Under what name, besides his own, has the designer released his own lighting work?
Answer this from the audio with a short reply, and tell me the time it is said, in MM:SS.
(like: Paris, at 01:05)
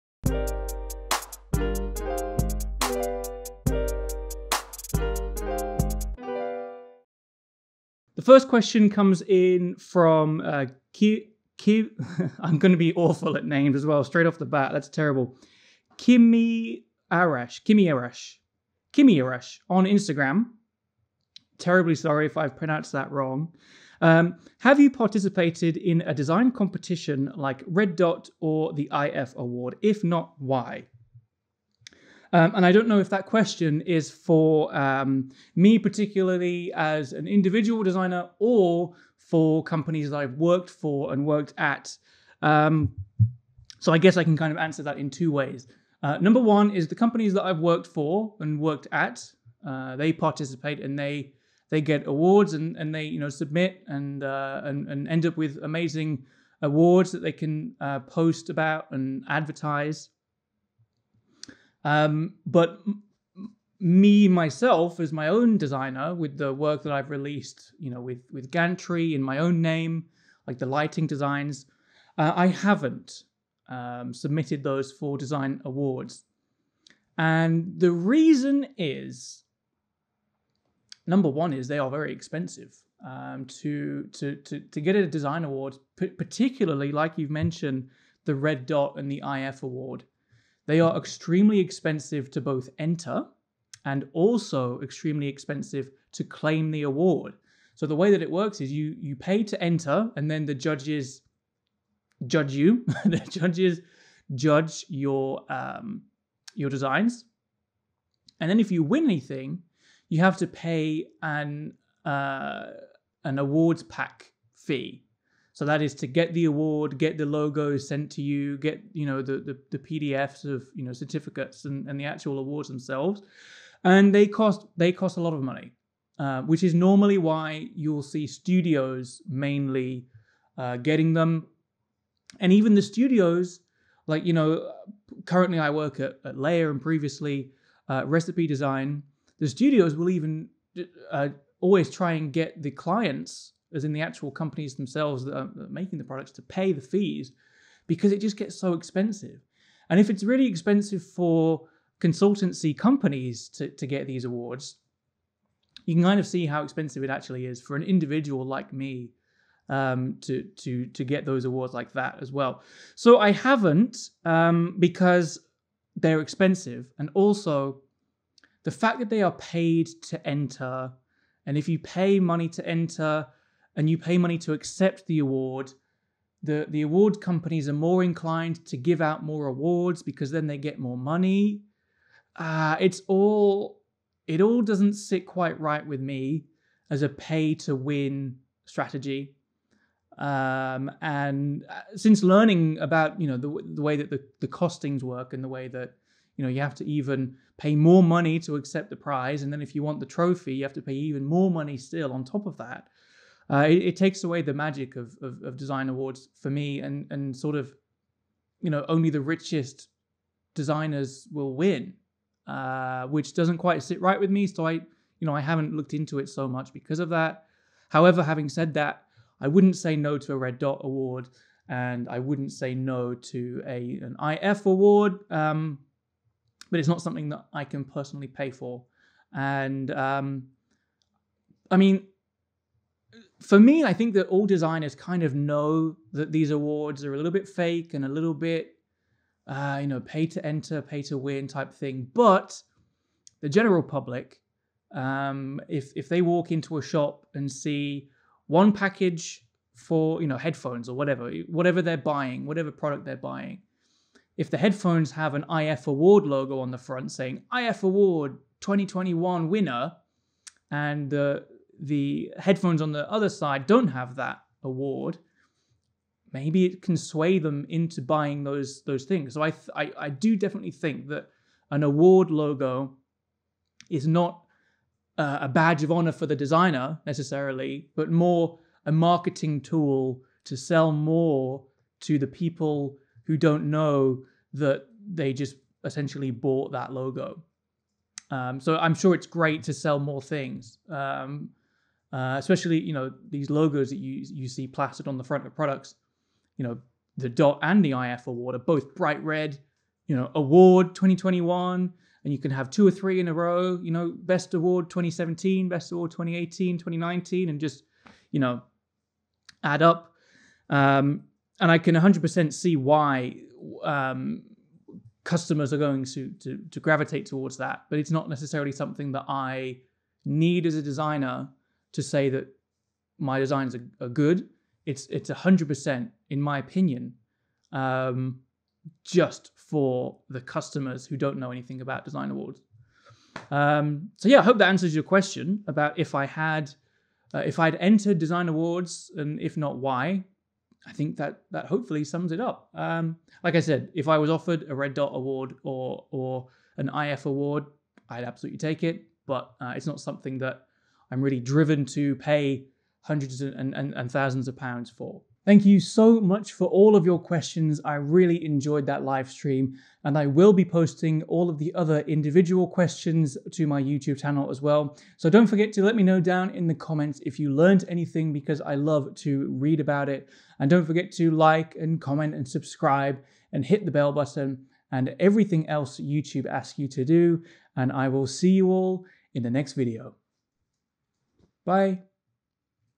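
Gantry, at 01:08.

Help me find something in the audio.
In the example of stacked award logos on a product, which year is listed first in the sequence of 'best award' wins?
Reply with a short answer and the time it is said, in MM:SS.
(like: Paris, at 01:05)
2017, at 05:04.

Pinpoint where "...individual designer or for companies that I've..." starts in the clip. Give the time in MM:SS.
00:37.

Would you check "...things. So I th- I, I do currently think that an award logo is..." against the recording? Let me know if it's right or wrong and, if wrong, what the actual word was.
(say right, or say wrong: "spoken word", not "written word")
wrong: "definitely", not "currently".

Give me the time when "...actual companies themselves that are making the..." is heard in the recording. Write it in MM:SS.
02:24.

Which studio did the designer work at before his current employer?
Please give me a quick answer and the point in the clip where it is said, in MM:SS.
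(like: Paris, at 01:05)
Recipe Design, at 02:18.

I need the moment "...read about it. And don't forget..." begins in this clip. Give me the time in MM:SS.
06:09.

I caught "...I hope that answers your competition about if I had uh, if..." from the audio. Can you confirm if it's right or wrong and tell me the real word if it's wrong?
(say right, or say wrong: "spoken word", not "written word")
wrong: "question", not "competition".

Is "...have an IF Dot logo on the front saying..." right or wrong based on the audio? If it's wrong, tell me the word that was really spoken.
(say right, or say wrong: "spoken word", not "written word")
wrong: "Award", not "Dot".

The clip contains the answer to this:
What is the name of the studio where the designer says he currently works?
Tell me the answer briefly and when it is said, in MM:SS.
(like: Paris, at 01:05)
Layer, at 02:16.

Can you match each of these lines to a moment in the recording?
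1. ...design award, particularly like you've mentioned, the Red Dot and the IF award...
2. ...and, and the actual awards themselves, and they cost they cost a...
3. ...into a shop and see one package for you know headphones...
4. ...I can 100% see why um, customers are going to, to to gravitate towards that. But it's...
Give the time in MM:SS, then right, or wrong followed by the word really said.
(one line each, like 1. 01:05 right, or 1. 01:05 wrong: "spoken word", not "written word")
1. 01:25 right
2. 02:01 right
3. 04:06 right
4. 05:11 right.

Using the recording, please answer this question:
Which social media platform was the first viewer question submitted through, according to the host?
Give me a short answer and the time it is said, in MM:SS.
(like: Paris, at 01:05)
Instagram, at 00:19.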